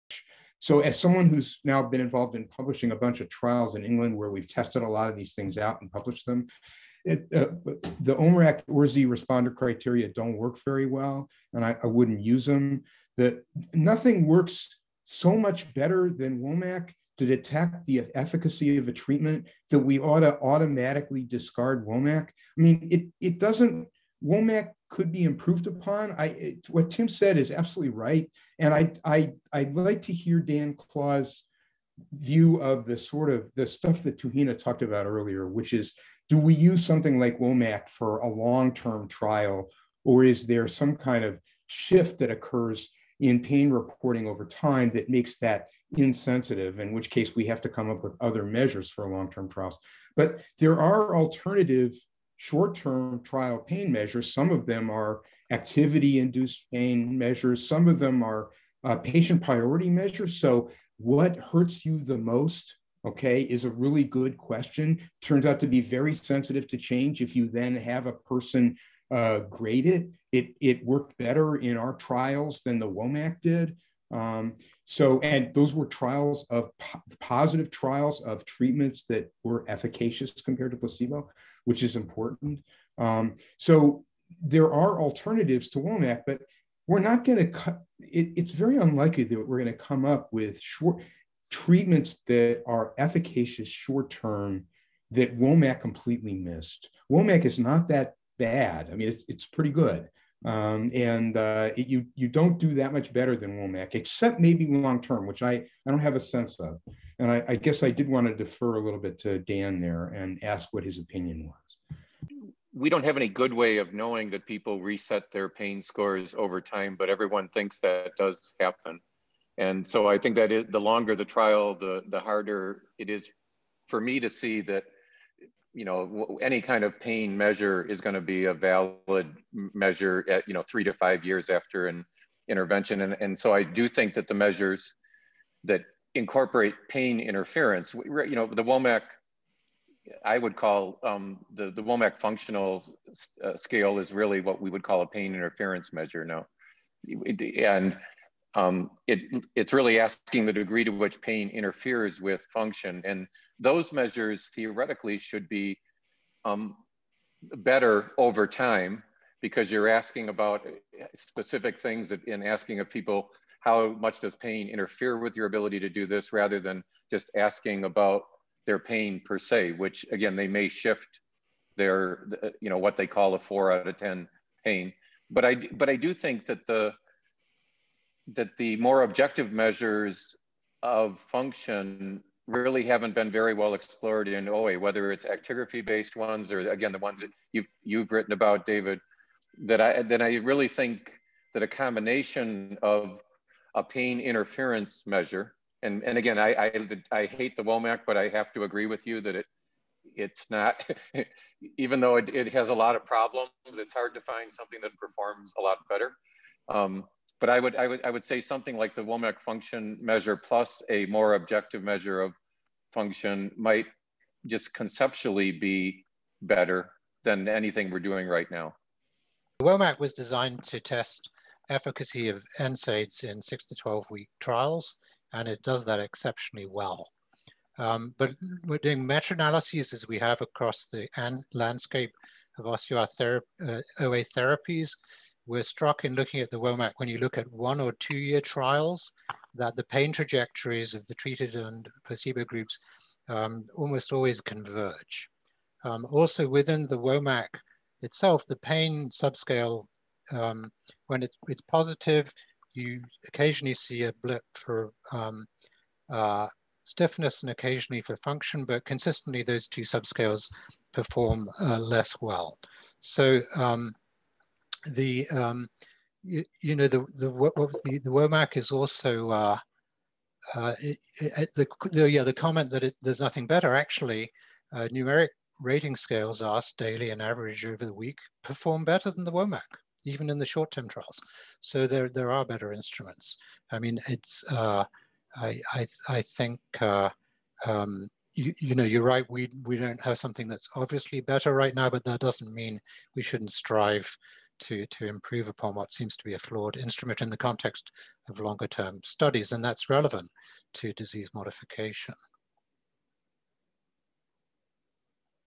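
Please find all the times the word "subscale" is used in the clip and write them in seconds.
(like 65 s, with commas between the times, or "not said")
249 s, 259 s.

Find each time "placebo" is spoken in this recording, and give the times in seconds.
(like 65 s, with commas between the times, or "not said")
80 s, 242 s.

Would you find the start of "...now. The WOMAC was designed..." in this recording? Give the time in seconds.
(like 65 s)
218 s.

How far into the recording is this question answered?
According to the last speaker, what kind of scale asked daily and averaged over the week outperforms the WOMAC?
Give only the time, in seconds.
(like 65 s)
274 s.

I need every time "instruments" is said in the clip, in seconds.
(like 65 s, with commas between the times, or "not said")
282 s, 296 s.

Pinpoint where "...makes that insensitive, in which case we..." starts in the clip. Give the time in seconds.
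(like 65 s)
45 s.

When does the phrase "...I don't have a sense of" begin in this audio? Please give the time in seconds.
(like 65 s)
105 s.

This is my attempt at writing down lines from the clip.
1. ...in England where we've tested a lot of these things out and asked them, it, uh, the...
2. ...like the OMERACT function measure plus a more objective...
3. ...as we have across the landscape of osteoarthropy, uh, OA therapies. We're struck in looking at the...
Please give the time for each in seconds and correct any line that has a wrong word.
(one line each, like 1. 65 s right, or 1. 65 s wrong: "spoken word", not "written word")
1. 3 s wrong: "published", not "asked"
2. 208 s wrong: "WOMAC", not "OMERACT"
3. 229 s right.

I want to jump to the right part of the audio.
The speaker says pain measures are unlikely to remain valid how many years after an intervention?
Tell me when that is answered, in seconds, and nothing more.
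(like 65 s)
130 s.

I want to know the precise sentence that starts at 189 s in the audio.
That I that I really think that a combination of a pain interference measure.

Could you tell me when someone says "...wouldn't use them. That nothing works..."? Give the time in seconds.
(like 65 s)
11 s.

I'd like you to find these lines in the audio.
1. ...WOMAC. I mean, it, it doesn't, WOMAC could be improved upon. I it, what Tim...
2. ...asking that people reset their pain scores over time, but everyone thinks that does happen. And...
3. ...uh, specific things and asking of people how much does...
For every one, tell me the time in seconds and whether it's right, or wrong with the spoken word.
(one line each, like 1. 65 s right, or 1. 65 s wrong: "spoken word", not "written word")
1. 21 s right
2. 113 s wrong: "knowing", not "asking"
3. 160 s right.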